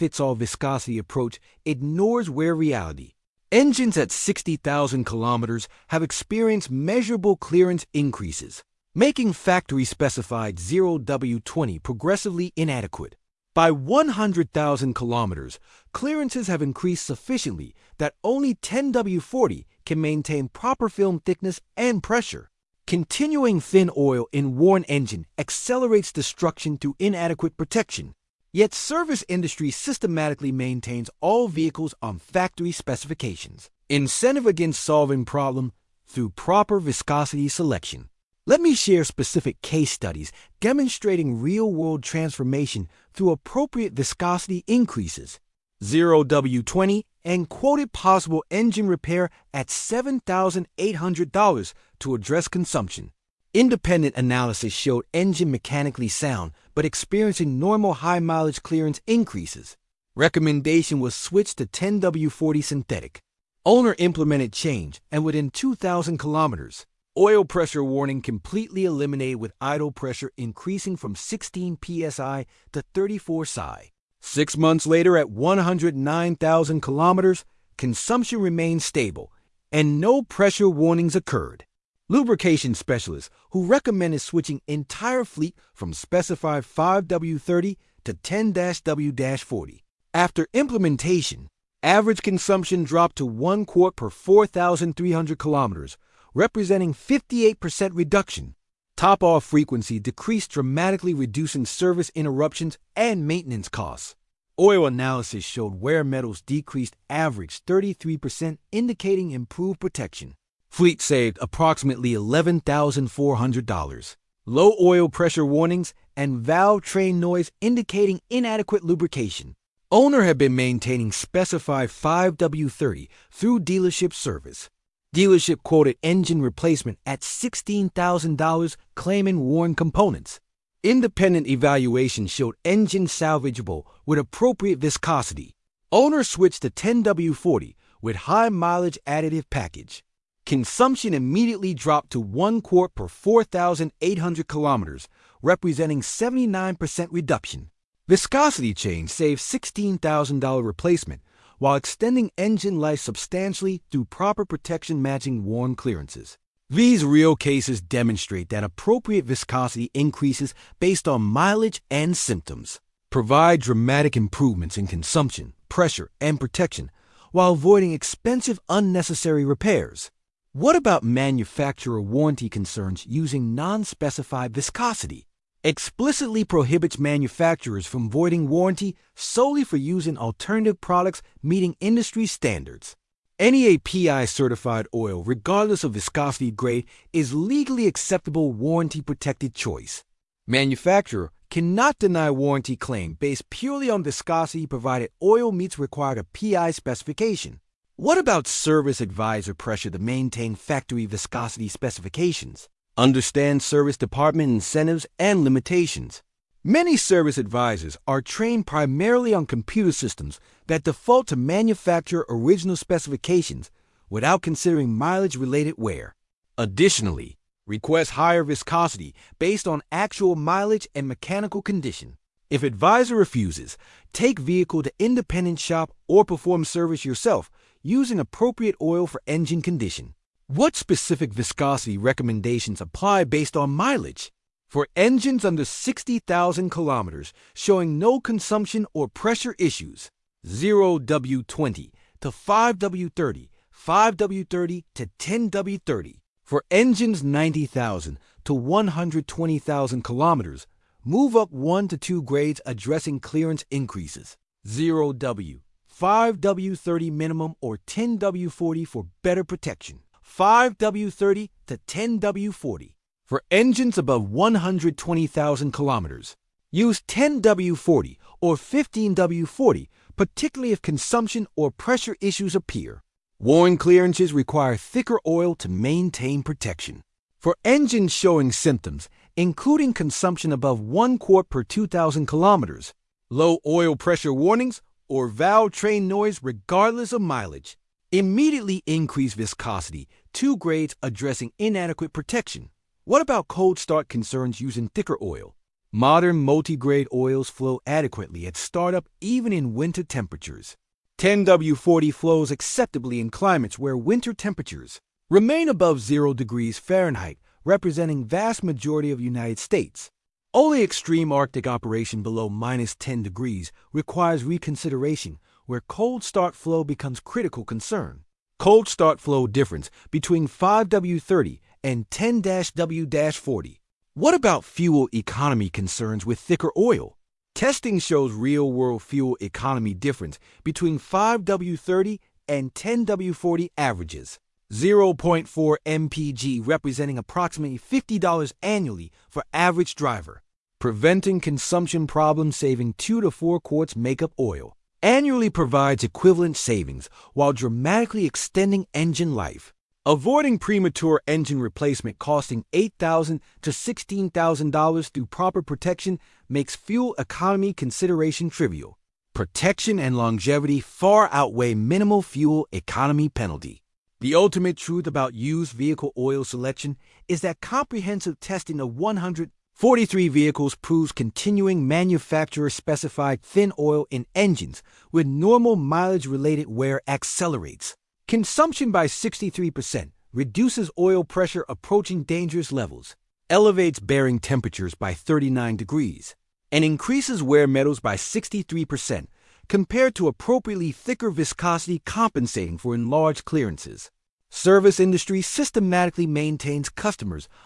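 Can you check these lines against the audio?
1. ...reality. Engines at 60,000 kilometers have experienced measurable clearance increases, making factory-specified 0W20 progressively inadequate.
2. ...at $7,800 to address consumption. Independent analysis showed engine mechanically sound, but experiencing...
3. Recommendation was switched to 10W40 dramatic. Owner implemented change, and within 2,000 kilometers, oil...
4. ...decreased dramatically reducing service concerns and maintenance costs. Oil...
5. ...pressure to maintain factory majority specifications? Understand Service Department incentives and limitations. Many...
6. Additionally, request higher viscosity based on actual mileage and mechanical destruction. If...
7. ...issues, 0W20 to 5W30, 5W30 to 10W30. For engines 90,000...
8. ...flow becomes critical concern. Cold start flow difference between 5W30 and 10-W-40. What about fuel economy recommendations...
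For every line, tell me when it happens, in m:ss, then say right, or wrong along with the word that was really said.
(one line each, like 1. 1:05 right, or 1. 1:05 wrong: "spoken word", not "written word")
1. 0:02 right
2. 0:49 right
3. 1:00 wrong: "synthetic", not "dramatic"
4. 1:39 wrong: "interruptions", not "concerns"
5. 3:19 wrong: "viscosity", not "majority"
6. 3:36 wrong: "condition", not "destruction"
7. 3:59 right
8. 5:16 wrong: "concerns", not "recommendations".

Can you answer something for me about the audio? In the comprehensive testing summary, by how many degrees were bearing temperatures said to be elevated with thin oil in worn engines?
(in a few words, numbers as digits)
39 degrees.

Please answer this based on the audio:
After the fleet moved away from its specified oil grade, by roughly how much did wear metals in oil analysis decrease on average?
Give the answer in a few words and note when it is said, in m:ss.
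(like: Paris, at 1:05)
33%, at 1:47.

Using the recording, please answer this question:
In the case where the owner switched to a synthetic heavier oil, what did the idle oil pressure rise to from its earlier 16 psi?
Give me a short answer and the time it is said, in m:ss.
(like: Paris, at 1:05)
34 psi, at 1:12.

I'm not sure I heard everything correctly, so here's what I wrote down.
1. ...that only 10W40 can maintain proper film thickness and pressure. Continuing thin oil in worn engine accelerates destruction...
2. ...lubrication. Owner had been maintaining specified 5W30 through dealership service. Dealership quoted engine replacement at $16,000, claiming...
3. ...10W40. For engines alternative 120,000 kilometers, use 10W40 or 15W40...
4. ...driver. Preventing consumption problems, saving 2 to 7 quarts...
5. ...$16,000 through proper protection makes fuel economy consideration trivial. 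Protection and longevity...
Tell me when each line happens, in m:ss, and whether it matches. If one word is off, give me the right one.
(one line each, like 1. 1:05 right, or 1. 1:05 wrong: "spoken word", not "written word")
1. 0:17 right
2. 1:58 right
3. 4:21 wrong: "above", not "alternative"
4. 5:39 wrong: "4", not "7"
5. 5:53 right.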